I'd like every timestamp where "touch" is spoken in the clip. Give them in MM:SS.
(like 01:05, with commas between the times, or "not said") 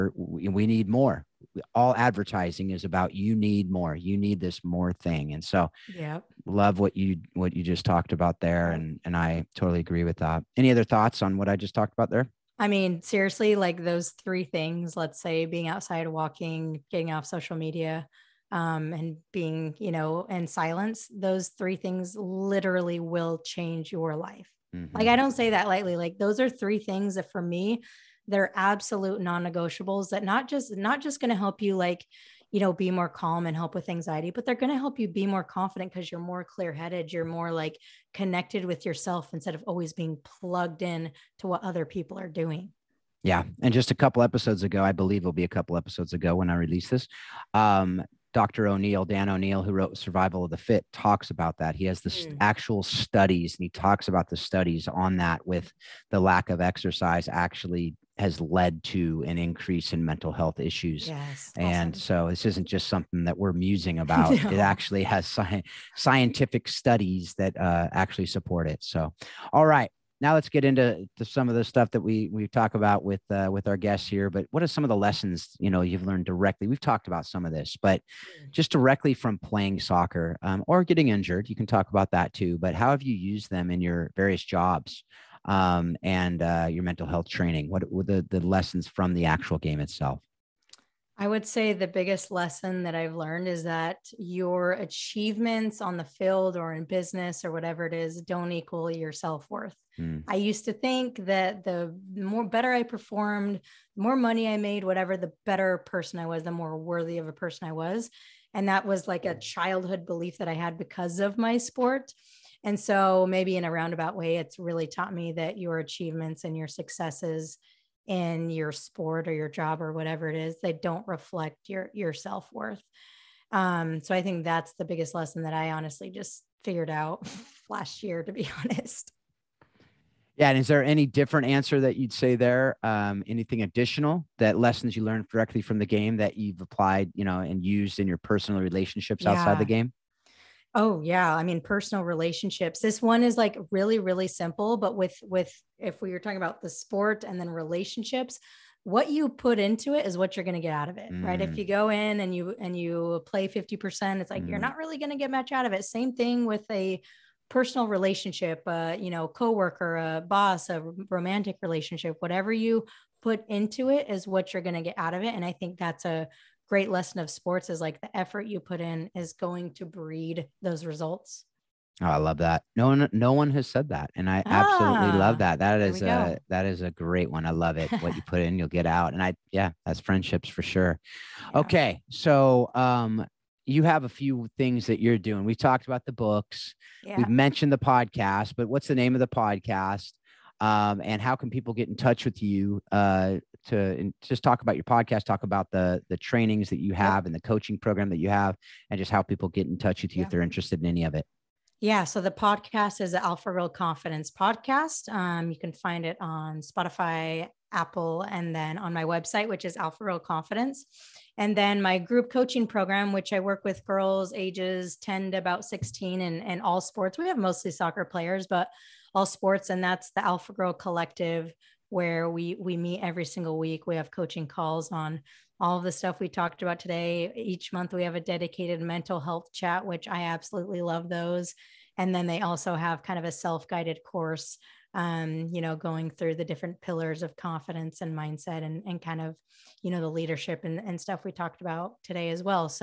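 03:11, 03:19.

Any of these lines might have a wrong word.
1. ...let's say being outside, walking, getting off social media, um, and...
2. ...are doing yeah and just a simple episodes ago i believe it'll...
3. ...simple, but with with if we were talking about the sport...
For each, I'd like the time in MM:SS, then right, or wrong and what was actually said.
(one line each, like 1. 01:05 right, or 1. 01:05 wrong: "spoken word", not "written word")
1. 00:14 right
2. 00:42 wrong: "couple", not "simple"
3. 02:24 right.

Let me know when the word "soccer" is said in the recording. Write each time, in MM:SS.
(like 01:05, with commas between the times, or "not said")
01:19, 03:37.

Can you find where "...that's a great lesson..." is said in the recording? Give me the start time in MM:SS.
02:45.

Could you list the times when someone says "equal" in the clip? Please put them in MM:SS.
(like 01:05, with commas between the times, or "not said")
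01:38.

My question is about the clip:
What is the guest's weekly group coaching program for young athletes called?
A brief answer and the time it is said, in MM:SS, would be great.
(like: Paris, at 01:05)
Alpha Girl Collective, at 03:40.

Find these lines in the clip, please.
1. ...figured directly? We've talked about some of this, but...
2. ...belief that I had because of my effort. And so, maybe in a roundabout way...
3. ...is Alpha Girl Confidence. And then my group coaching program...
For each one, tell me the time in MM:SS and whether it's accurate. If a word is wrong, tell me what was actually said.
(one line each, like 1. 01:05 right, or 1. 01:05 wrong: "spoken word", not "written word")
1. 01:16 wrong: "learned", not "figured"
2. 01:50 wrong: "sport", not "effort"
3. 03:29 right.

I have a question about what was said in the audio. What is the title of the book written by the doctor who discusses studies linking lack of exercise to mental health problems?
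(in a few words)
Survival of the Fit.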